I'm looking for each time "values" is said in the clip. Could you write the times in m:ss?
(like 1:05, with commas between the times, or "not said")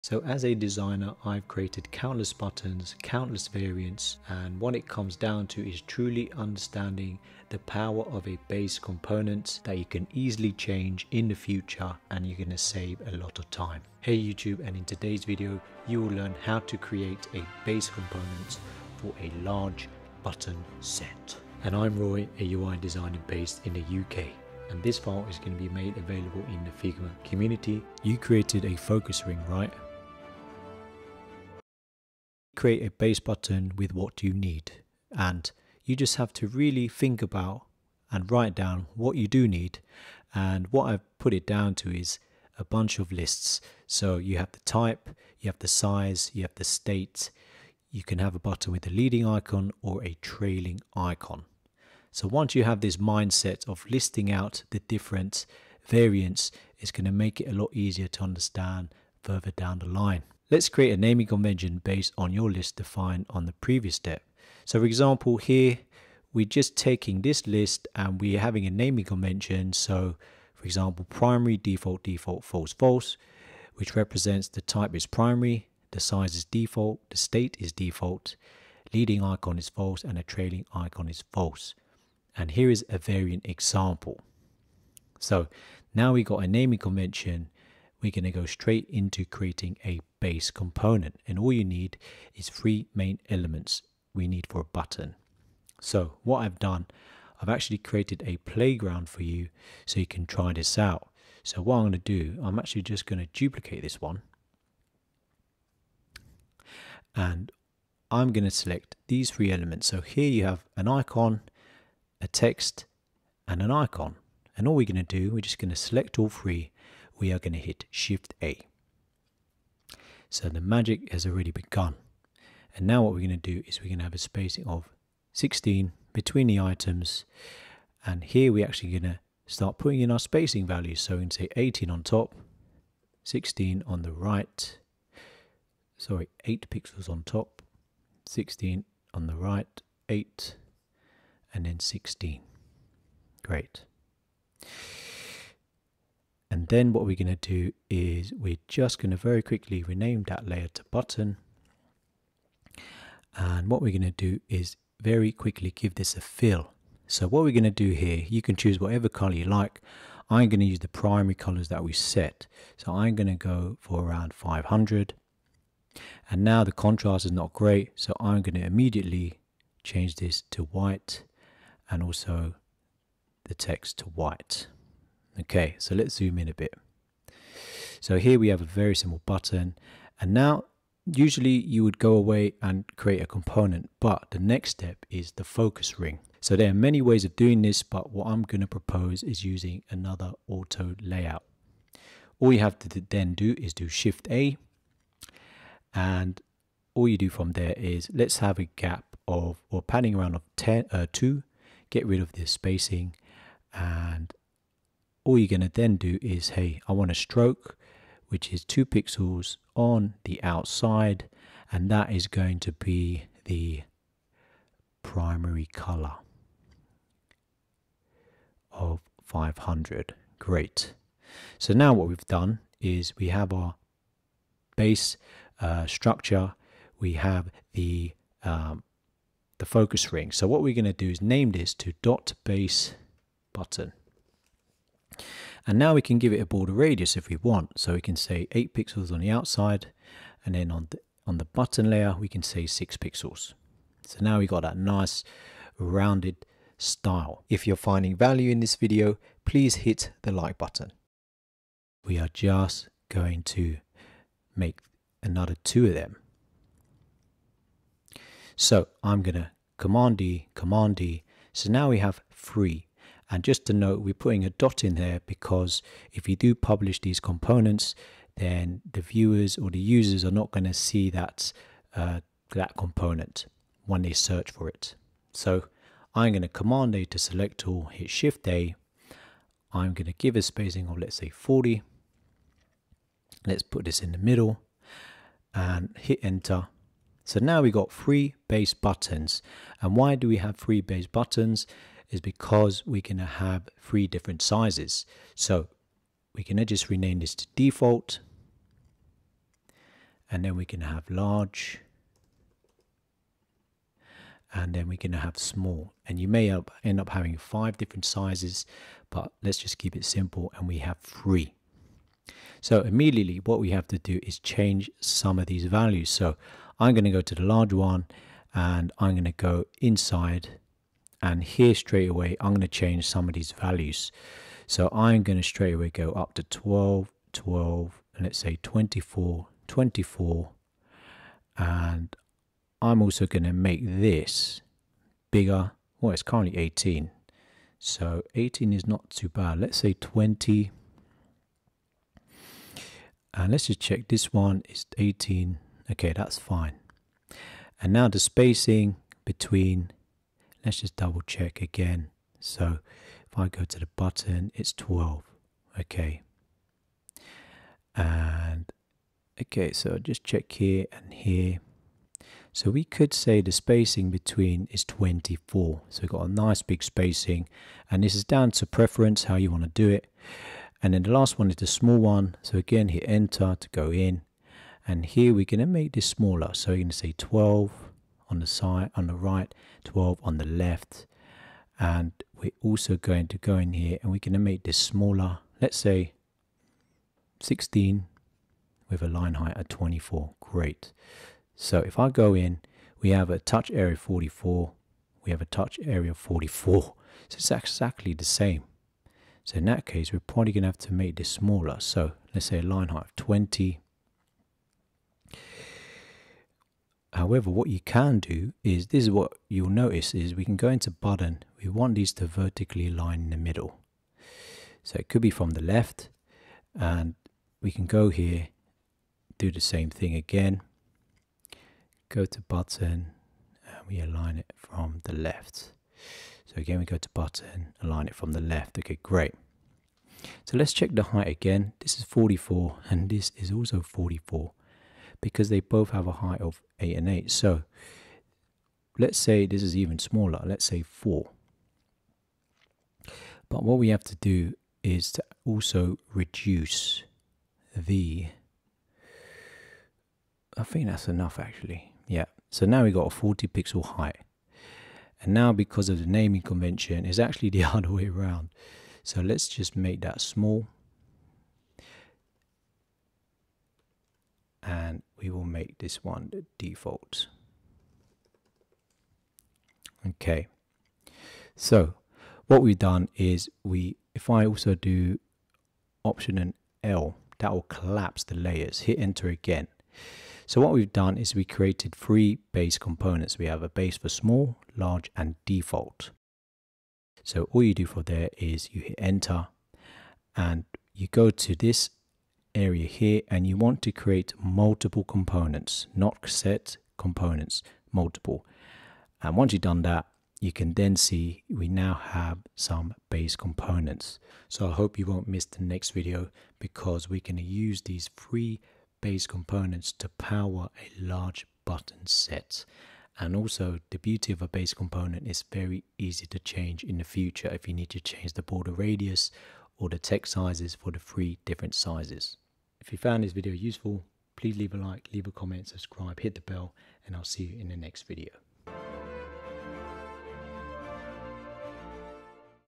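2:10, 4:08, 5:15, 5:23.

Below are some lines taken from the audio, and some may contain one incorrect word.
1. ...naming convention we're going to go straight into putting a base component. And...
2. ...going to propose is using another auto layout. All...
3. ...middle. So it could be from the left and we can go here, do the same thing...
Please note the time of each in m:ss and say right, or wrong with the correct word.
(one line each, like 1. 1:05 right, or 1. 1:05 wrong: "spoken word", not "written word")
1. 1:26 wrong: "creating", not "putting"
2. 3:08 right
3. 6:53 right.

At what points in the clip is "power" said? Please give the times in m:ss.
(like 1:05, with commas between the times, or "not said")
0:07, 8:30.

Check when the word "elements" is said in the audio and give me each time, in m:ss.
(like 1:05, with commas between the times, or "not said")
1:33, 1:49.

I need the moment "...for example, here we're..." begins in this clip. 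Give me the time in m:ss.
1:04.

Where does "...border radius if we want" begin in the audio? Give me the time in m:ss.
3:56.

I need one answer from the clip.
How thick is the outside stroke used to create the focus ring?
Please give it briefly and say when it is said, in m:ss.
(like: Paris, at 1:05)
2 pixels, at 3:28.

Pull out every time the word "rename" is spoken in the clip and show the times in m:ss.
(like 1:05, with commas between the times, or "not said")
2:29, 4:56.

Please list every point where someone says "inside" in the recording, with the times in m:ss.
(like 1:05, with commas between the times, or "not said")
5:19.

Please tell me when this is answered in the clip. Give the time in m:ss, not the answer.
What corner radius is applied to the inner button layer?
4:02.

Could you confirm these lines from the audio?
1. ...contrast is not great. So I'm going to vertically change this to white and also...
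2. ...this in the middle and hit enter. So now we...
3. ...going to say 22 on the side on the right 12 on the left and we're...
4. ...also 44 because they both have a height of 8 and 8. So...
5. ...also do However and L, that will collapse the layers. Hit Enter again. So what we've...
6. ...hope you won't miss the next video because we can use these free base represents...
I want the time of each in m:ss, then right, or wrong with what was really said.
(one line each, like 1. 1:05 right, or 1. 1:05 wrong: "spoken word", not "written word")
1. 2:46 wrong: "immediately", not "vertically"
2. 4:43 right
3. 6:16 wrong: "12", not "22"
4. 7:13 right
5. 7:54 wrong: "Option", not "However"
6. 8:24 wrong: "components", not "represents".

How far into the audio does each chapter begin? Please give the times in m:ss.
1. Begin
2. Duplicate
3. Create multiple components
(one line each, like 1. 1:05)
1. 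0:31
2. 4:11
3. 8:06.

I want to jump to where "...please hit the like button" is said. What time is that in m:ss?
4:09.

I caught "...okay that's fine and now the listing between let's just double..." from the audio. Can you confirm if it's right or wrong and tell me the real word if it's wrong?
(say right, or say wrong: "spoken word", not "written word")
wrong: "spacing", not "listing".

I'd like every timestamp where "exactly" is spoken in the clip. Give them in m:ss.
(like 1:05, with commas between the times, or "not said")
6:37.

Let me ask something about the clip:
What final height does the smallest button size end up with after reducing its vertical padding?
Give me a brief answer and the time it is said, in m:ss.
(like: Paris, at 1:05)
40 pixels, at 7:33.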